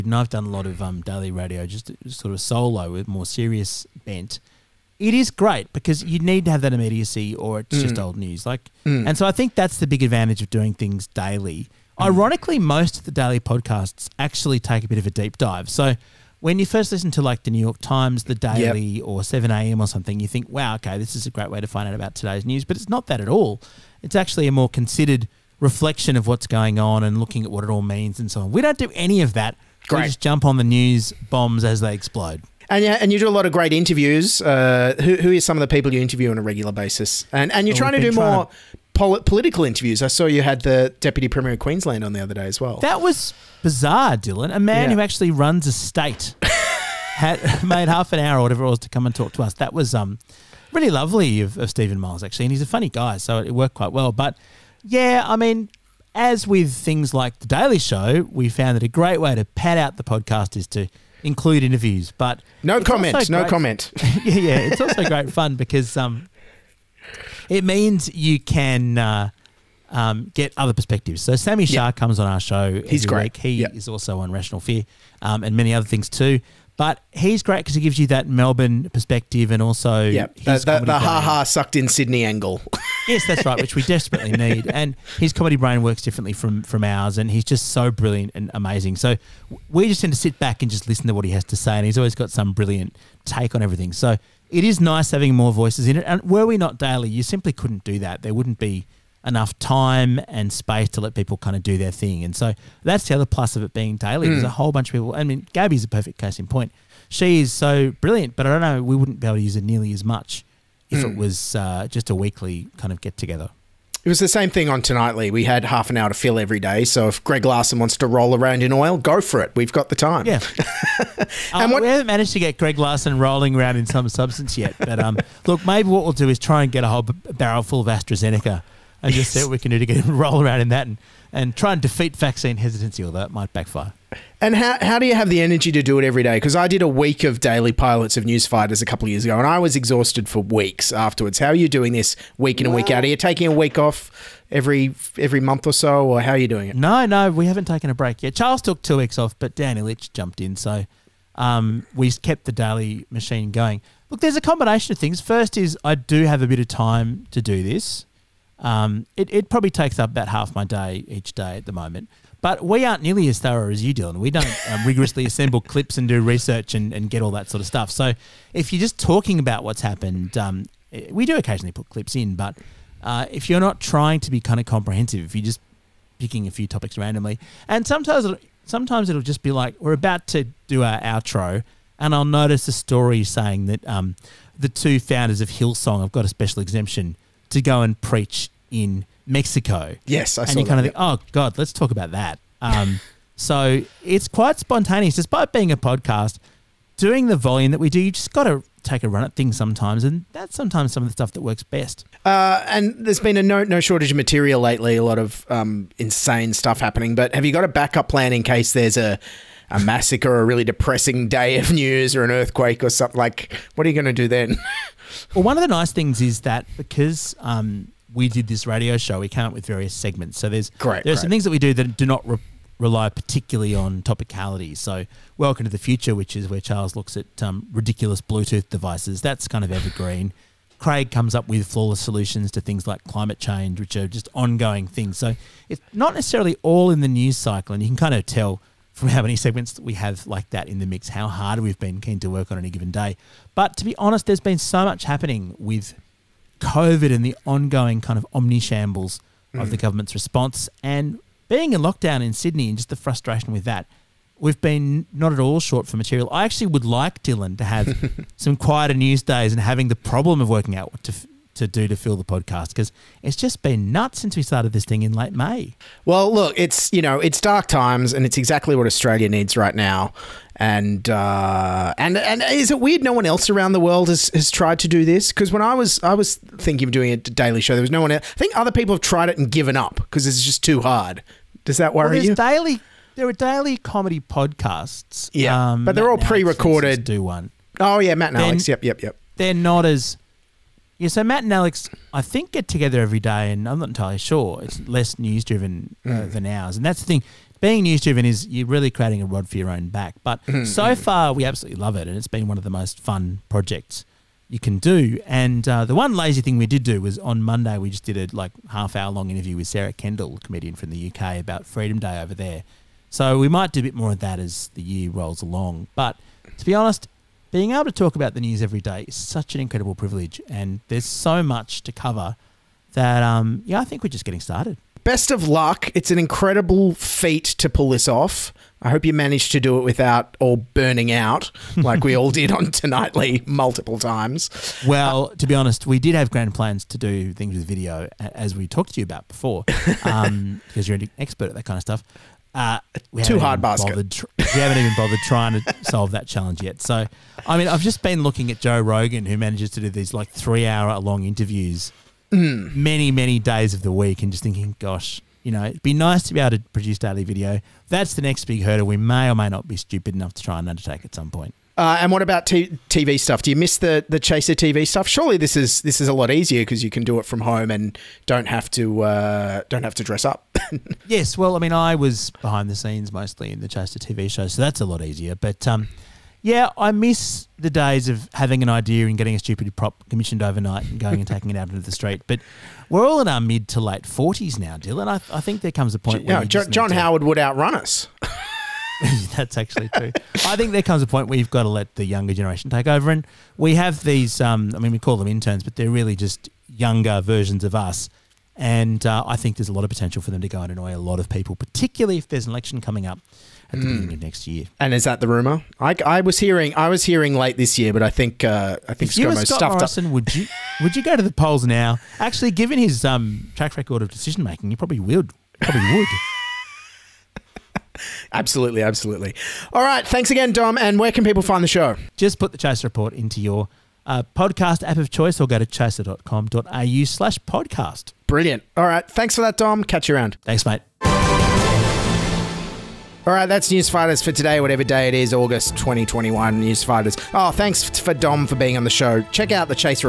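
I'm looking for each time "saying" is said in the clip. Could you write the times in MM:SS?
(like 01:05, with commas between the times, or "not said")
03:03.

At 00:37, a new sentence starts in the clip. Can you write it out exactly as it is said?
And and you're oh, trying to do more Pol political interviews.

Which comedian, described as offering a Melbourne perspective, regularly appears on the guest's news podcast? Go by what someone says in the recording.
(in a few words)
Sami Shah.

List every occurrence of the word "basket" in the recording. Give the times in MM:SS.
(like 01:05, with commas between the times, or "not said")
05:43.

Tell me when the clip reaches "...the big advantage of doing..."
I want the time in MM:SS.
00:09.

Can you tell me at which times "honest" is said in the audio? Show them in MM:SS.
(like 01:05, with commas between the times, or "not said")
04:03, 05:16, 05:35.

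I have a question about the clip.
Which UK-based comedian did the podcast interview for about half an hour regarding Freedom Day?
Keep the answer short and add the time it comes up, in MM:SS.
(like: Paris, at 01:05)
Sarah Kendall, at 05:09.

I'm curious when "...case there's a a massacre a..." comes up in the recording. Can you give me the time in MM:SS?
03:28.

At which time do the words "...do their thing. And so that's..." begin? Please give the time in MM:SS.
01:41.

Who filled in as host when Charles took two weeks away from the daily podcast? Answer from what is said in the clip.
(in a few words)
Dan Ilic.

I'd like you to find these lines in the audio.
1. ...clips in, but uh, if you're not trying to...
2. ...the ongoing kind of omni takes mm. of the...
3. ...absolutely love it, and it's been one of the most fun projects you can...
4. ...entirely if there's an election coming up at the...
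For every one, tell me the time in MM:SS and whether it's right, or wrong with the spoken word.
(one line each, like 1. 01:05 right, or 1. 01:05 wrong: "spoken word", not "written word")
1. 02:51 right
2. 04:07 wrong: "shambles", not "takes"
3. 05:01 right
4. 06:41 wrong: "particularly", not "entirely".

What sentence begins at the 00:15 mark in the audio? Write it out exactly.
So when you first listen to like the New York Times, the Daily, yep.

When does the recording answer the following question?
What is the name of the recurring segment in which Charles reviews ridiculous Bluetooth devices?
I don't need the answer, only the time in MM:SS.
03:45.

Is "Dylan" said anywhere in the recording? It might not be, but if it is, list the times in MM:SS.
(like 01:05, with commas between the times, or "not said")
00:44, 02:43, 04:17, 06:24.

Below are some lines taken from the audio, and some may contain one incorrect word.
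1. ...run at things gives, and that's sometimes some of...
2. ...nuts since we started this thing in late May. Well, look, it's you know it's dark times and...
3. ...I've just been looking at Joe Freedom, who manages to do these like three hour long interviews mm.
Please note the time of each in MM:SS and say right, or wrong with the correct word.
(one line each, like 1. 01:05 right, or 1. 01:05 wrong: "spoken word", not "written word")
1. 03:19 wrong: "sometimes", not "gives"
2. 04:23 right
3. 05:47 wrong: "Rogan", not "Freedom".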